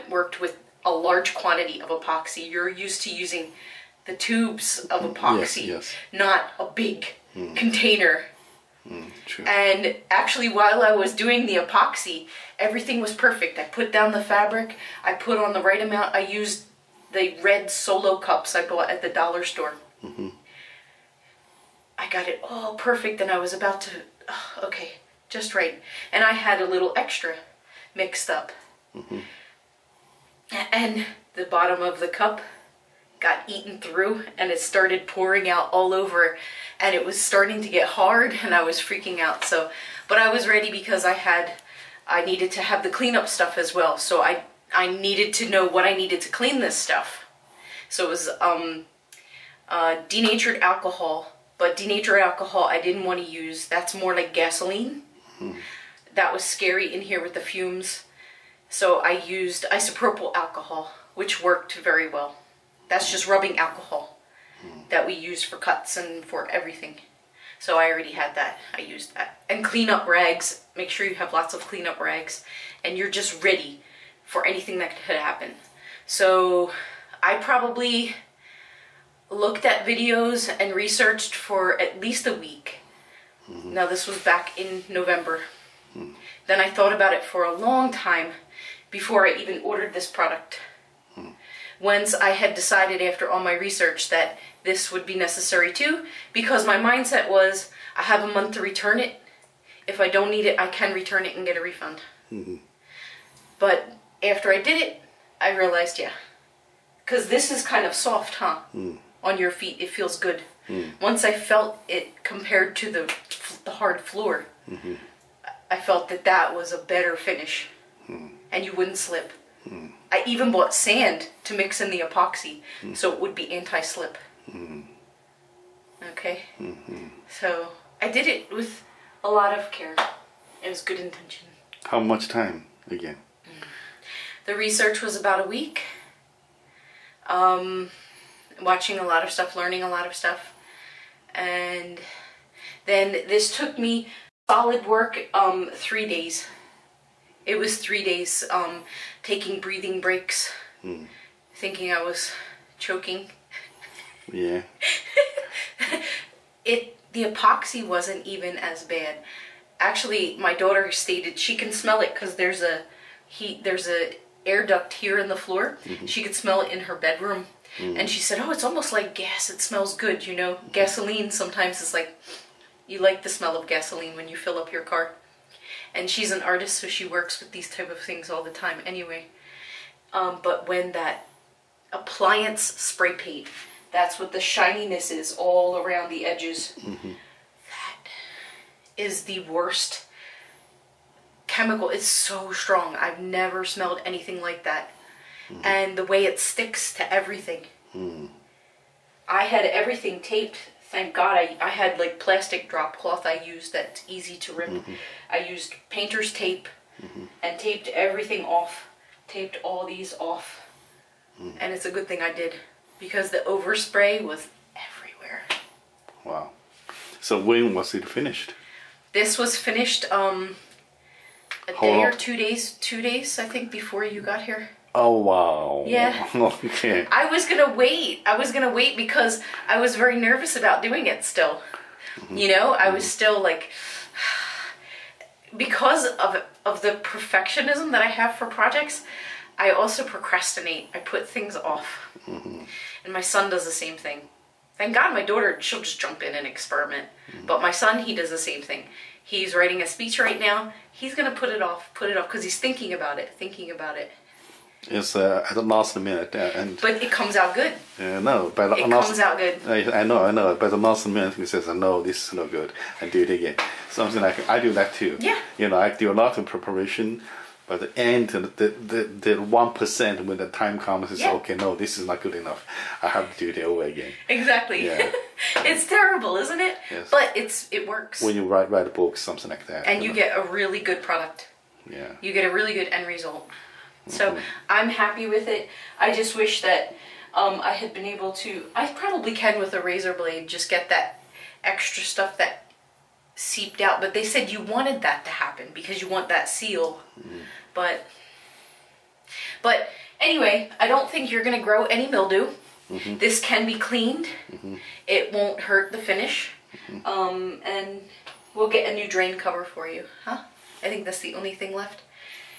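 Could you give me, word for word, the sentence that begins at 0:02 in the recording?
You're used to using the tubes of epoxy, yes, yes.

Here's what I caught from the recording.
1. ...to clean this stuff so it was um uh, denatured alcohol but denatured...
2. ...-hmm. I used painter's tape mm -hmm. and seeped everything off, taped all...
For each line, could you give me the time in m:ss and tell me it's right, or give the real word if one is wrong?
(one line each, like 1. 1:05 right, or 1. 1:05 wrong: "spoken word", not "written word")
1. 0:46 right
2. 3:24 wrong: "taped", not "seeped".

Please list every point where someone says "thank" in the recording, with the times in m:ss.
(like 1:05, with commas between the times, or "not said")
3:20, 4:04.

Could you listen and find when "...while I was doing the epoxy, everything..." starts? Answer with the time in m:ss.
0:10.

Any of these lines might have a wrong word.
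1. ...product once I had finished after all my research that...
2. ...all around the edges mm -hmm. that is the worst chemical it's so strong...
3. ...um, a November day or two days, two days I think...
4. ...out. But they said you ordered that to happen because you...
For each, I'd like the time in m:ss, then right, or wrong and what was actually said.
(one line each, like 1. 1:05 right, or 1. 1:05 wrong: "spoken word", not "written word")
1. 1:30 wrong: "decided", not "finished"
2. 3:05 right
3. 3:40 wrong: "Hold", not "November"
4. 4:53 wrong: "wanted", not "ordered".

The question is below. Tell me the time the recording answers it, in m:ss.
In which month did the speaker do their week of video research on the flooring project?
1:24.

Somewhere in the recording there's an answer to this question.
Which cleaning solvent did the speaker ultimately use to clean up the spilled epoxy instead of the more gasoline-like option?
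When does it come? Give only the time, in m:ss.
0:59.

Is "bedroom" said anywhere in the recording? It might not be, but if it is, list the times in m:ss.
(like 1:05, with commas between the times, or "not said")
2:46.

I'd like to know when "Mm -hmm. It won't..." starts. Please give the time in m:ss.
5:04.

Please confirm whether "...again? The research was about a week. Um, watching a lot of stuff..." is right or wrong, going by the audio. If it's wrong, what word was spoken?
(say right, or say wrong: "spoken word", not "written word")
right.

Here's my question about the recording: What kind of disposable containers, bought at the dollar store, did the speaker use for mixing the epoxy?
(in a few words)
red solo cups.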